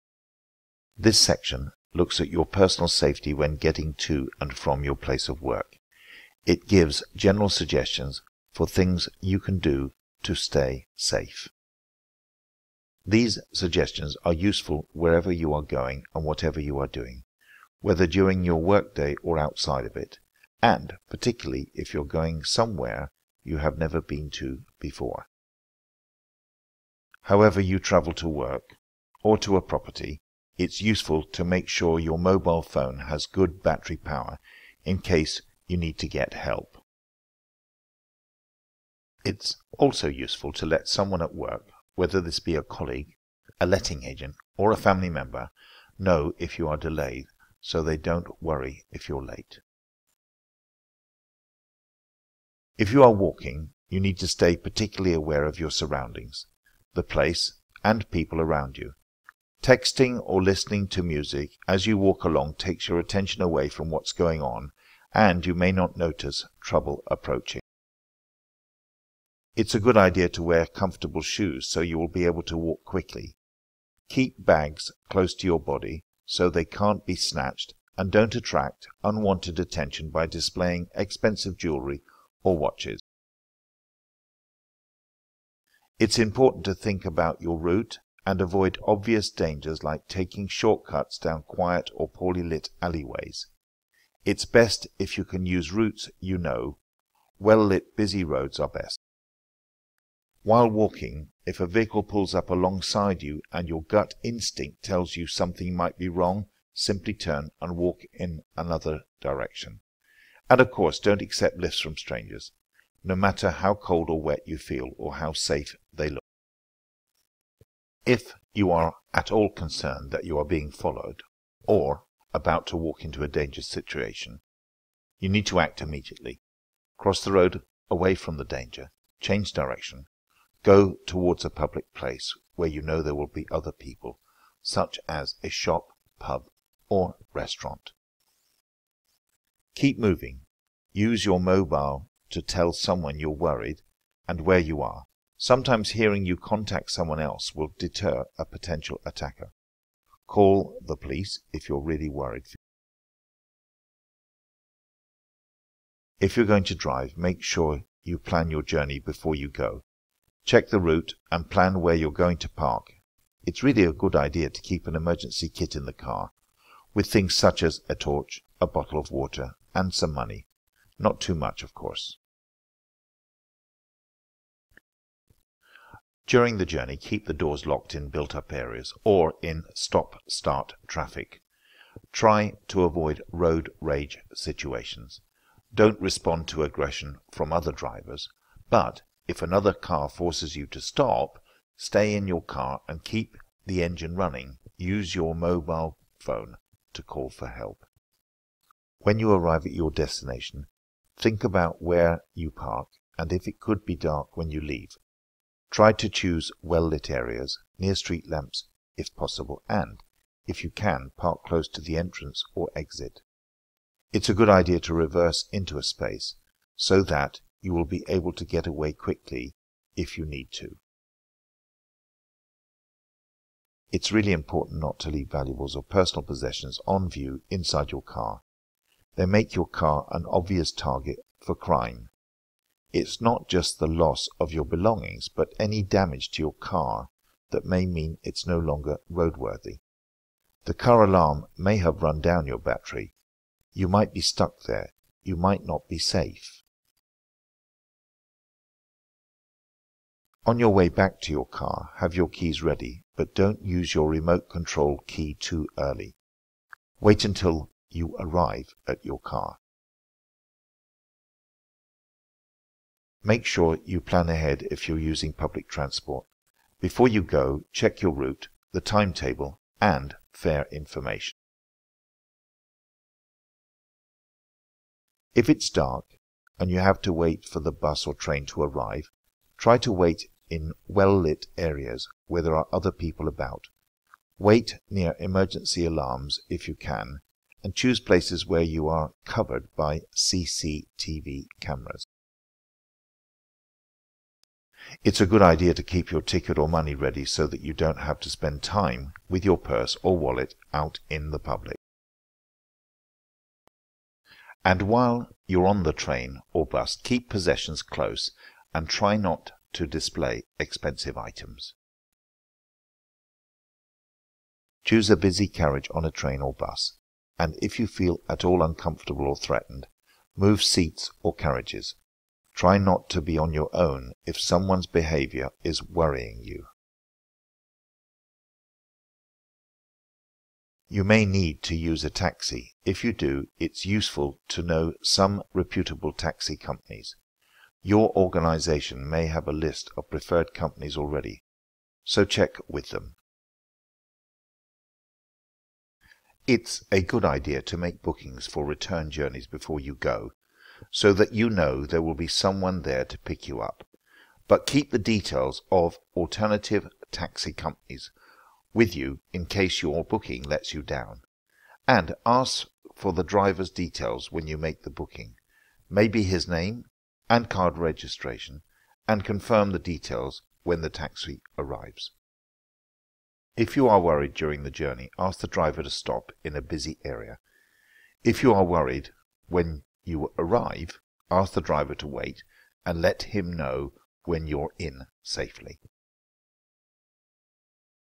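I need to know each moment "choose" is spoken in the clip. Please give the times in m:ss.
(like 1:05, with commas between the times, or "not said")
3:26, 4:47, 5:14.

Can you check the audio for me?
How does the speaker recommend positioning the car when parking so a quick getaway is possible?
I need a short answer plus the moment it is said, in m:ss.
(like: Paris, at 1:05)
reverse into a space, at 3:34.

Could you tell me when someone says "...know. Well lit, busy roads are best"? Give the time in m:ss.
1:36.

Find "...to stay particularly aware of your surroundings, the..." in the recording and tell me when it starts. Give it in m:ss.
0:54.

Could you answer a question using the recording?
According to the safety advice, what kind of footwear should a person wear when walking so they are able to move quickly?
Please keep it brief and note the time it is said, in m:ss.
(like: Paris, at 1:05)
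comfortable shoes, at 1:10.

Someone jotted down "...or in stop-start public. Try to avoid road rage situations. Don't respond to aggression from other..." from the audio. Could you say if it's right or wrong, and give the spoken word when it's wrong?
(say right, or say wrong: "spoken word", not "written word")
wrong: "traffic", not "public".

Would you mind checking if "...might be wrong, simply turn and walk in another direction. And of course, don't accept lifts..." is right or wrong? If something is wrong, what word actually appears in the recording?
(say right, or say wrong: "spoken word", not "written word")
right.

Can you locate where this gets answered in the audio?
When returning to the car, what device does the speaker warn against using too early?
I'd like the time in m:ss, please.
4:14.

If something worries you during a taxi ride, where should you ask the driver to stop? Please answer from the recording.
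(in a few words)
a busy area.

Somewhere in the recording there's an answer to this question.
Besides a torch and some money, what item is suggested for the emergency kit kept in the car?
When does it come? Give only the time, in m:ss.
2:48.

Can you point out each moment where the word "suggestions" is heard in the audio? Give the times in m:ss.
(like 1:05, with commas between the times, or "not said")
0:07, 0:13.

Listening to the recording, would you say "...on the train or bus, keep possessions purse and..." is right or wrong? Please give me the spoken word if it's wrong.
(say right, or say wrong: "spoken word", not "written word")
wrong: "close", not "purse".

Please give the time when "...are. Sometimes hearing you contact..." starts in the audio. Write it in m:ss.
2:24.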